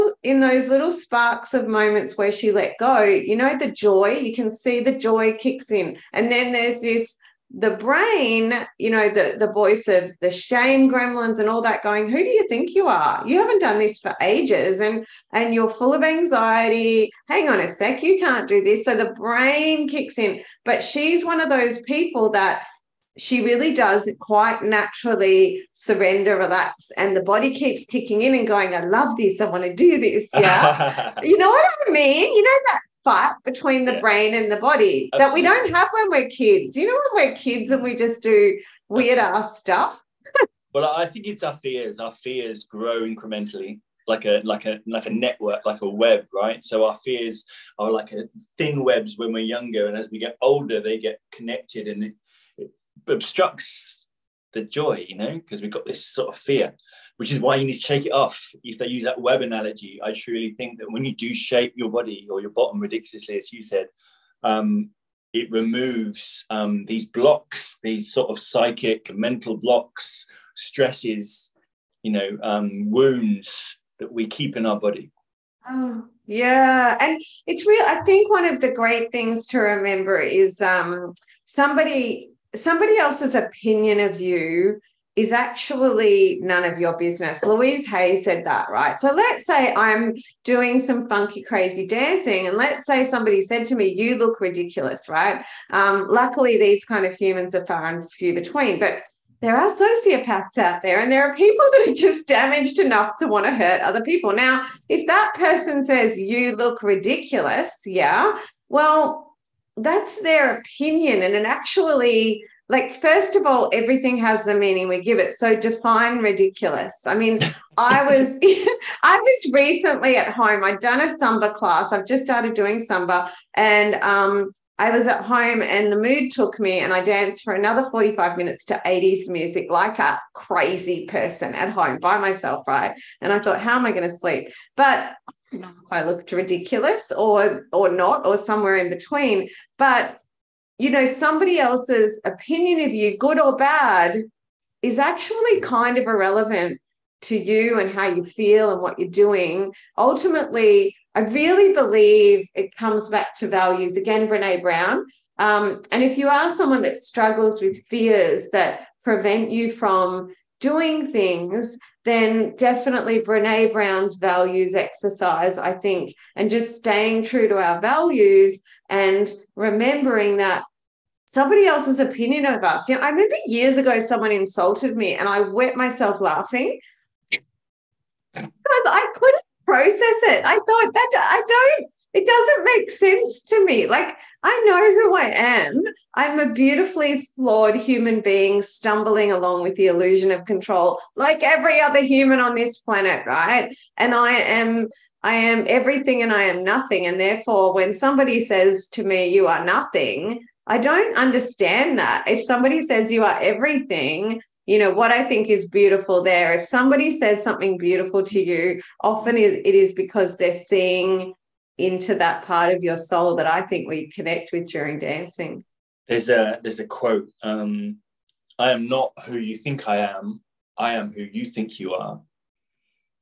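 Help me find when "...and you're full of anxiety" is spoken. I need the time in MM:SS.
00:15.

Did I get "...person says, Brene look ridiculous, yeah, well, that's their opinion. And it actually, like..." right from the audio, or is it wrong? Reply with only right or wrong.
wrong.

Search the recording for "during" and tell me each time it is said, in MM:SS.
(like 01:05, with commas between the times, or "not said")
03:34.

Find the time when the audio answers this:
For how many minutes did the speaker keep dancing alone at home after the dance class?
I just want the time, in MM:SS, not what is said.
02:07.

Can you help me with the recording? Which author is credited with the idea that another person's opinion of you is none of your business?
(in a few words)
Louise Hay.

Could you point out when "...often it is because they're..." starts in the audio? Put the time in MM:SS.
03:29.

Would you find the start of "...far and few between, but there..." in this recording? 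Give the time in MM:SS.
01:37.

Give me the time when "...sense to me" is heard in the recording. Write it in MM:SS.
03:02.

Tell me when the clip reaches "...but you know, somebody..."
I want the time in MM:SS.
02:19.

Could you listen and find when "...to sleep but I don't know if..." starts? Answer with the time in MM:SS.
02:14.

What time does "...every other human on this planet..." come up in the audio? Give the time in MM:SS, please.
03:11.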